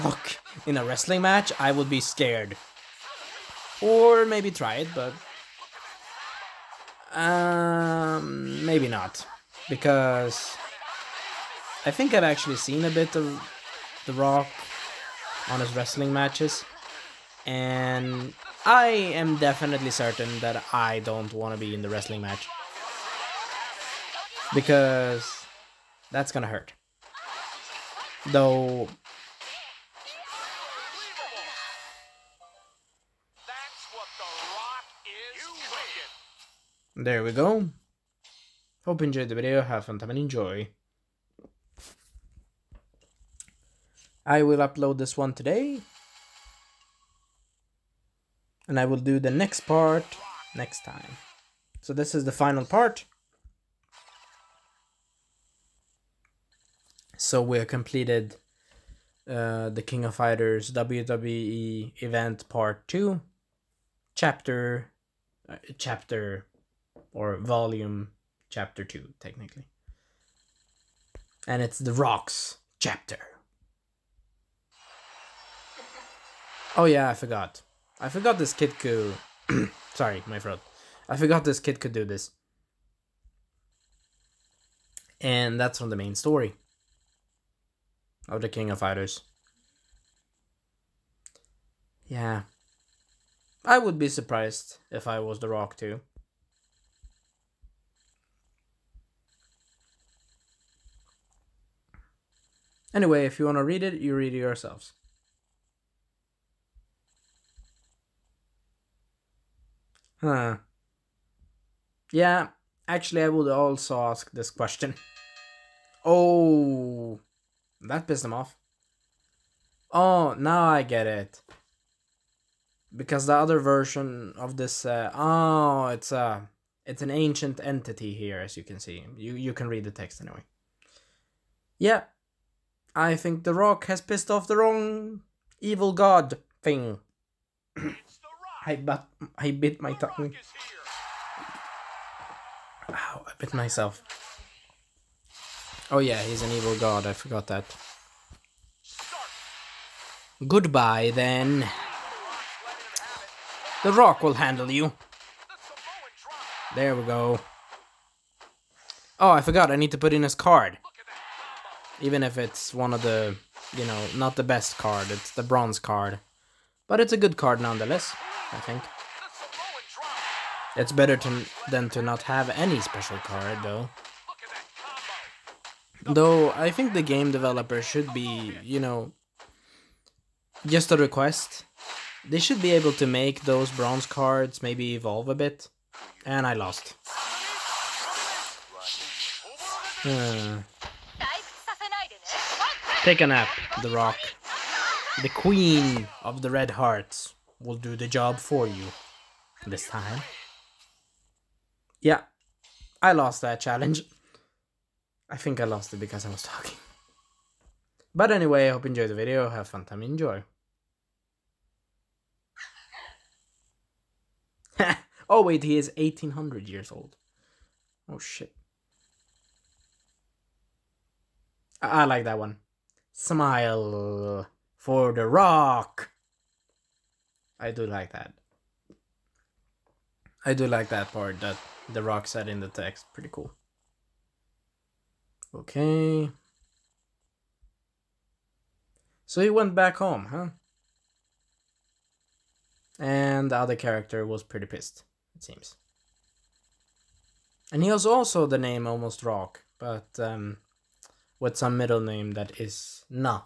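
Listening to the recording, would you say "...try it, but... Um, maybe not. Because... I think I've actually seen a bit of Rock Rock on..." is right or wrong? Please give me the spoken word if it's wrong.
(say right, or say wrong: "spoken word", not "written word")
wrong: "The", not "Rock".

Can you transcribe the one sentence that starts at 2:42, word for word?
Even if it's one of the, you know, not the best card, it's the bronze card.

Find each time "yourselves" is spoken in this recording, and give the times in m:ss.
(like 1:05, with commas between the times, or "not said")
1:44.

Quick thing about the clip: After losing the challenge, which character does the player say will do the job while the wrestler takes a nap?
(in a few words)
Queen of the Red Hearts.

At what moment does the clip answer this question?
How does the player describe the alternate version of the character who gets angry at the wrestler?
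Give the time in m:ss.
2:07.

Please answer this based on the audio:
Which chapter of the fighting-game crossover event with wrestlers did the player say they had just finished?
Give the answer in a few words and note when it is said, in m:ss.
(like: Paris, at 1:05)
Chapter 2, at 1:08.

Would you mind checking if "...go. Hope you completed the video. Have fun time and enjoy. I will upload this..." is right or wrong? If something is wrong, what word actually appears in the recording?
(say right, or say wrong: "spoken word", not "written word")
wrong: "enjoyed", not "completed".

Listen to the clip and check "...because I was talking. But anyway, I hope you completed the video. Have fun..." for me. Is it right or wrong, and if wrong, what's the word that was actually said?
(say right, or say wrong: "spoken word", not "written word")
wrong: "enjoyed", not "completed".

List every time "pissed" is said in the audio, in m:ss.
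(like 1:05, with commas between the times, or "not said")
1:58, 2:13, 4:04.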